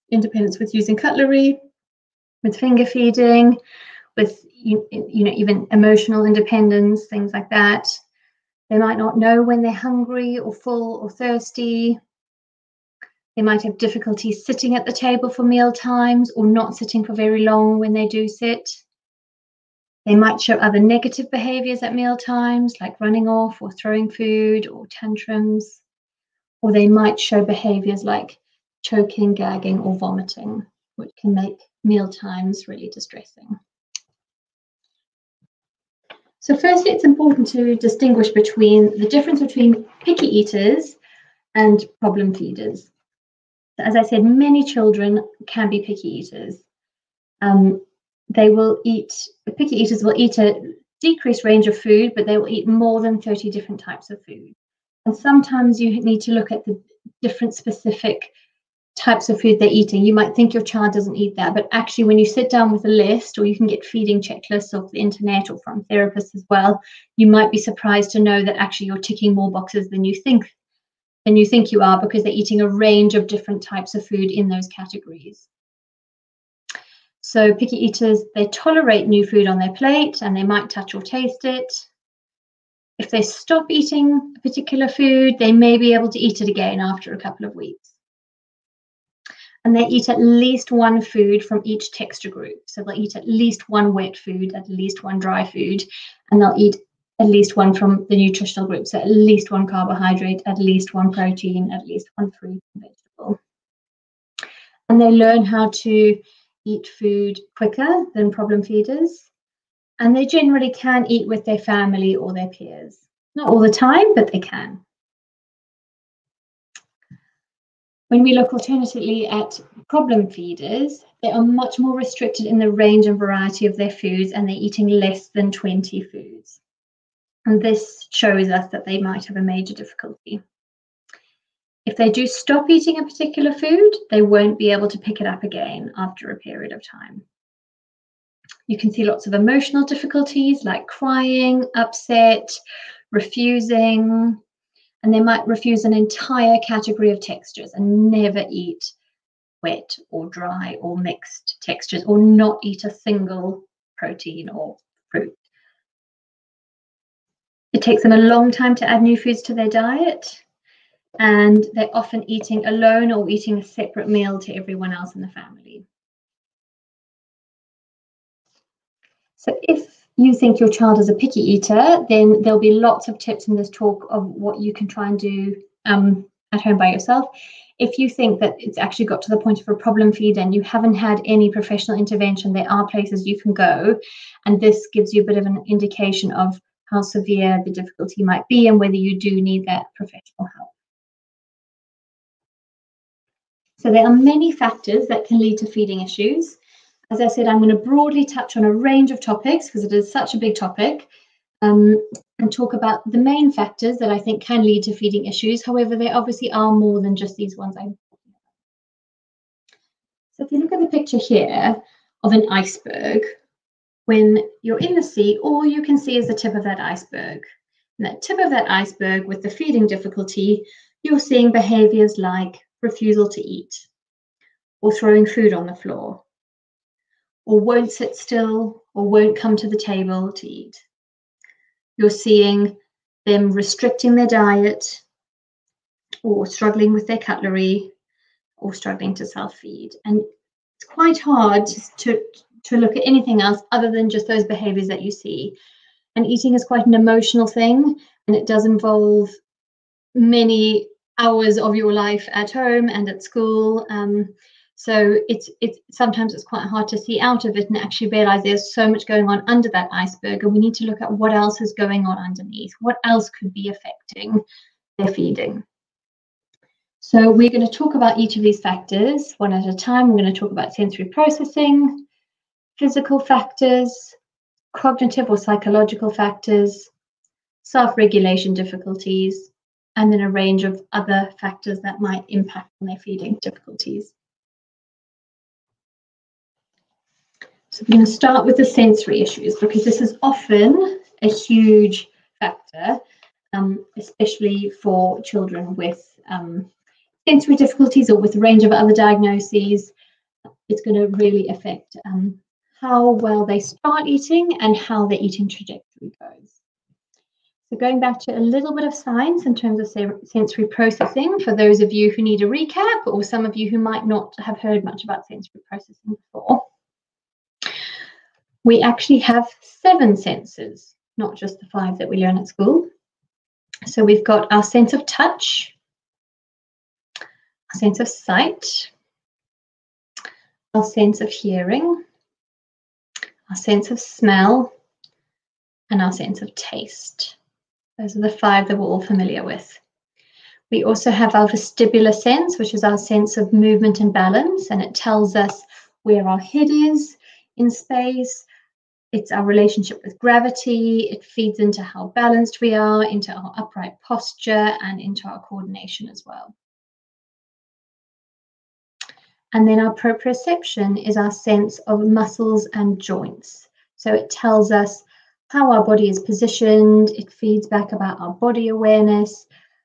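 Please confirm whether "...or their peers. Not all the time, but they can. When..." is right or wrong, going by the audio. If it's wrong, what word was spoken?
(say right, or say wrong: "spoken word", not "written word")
right.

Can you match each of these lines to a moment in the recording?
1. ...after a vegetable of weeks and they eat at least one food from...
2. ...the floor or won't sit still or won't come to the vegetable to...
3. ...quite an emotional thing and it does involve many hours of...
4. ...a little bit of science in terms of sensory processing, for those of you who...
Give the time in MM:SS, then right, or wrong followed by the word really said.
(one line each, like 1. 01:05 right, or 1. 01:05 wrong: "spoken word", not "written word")
1. 01:26 wrong: "couple", not "vegetable"
2. 03:45 wrong: "table", not "vegetable"
3. 04:06 right
4. 05:08 right.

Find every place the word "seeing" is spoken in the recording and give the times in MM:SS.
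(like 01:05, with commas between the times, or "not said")
03:41, 03:52.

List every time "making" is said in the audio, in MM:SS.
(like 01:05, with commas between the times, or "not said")
not said.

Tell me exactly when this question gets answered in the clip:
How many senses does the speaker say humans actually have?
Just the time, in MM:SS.
05:19.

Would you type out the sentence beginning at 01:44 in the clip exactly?
And they learn how to eat food quicker than problem feeders.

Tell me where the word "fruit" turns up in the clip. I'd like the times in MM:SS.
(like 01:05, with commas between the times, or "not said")
01:42, 02:35.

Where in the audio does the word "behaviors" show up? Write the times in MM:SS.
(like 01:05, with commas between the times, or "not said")
00:21, 00:27, 03:41, 04:04.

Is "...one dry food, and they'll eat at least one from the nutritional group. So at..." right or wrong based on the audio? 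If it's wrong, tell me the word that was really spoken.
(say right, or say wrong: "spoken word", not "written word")
right.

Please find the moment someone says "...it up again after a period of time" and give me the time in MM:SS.
02:15.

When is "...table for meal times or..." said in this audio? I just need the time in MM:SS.
00:14.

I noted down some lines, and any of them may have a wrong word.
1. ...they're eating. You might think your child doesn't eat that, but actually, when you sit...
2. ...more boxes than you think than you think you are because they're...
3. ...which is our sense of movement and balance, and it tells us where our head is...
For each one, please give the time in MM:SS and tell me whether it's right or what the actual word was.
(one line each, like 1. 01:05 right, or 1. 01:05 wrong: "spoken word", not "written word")
1. 00:59 right
2. 01:09 right
3. 05:42 right.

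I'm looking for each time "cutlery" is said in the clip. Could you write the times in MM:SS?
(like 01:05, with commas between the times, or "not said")
00:00, 03:57.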